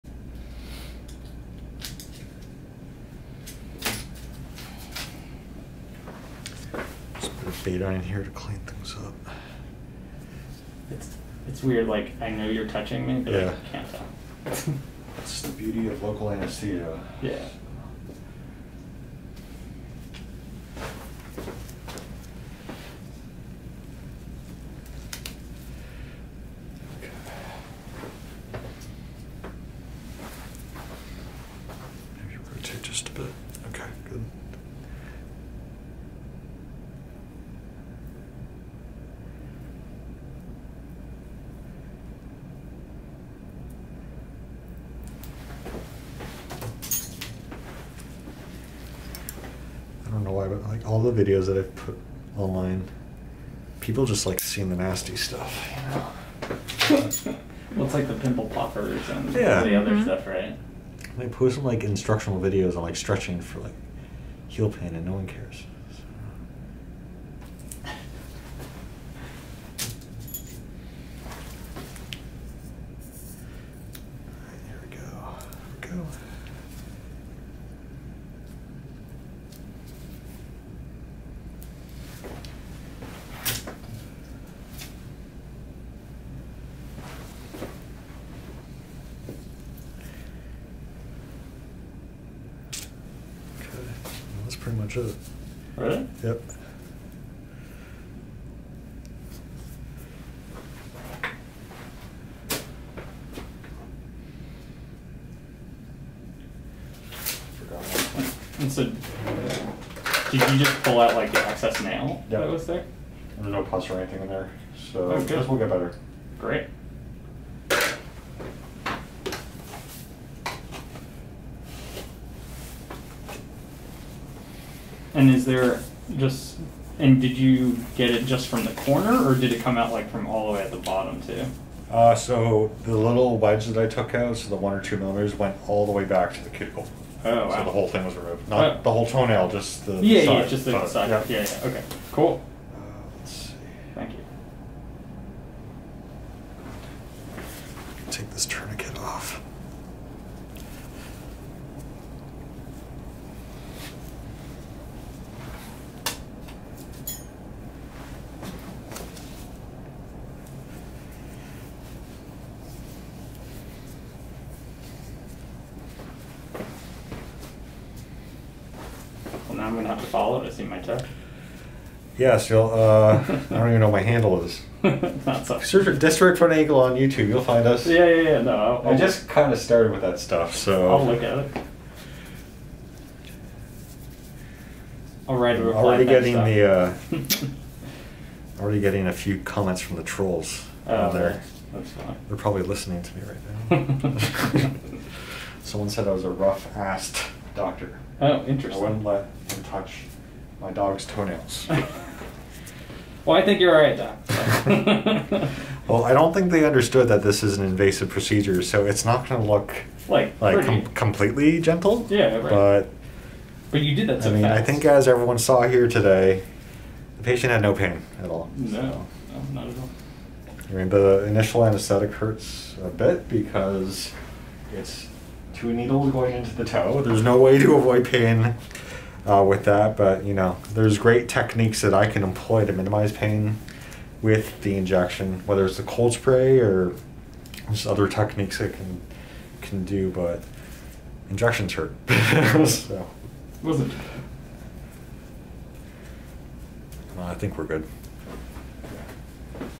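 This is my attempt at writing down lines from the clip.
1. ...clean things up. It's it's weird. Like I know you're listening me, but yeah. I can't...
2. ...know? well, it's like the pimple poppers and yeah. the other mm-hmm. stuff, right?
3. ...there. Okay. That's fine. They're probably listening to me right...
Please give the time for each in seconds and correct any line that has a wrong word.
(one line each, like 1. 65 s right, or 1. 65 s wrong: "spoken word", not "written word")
1. 8 s wrong: "touching", not "listening"
2. 56 s right
3. 191 s right.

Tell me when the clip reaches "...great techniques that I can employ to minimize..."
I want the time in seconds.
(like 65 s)
230 s.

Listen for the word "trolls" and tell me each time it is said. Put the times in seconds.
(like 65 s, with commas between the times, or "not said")
190 s.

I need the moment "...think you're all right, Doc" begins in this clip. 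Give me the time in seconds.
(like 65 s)
203 s.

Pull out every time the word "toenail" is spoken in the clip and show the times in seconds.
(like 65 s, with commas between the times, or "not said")
139 s, 201 s.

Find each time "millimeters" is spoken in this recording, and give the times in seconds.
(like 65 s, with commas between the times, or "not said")
134 s.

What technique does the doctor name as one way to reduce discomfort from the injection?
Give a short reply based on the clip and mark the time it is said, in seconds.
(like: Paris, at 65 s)
Cold spray, at 235 s.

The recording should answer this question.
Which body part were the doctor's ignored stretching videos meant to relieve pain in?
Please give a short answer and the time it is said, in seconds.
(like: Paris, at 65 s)
Heel, at 64 s.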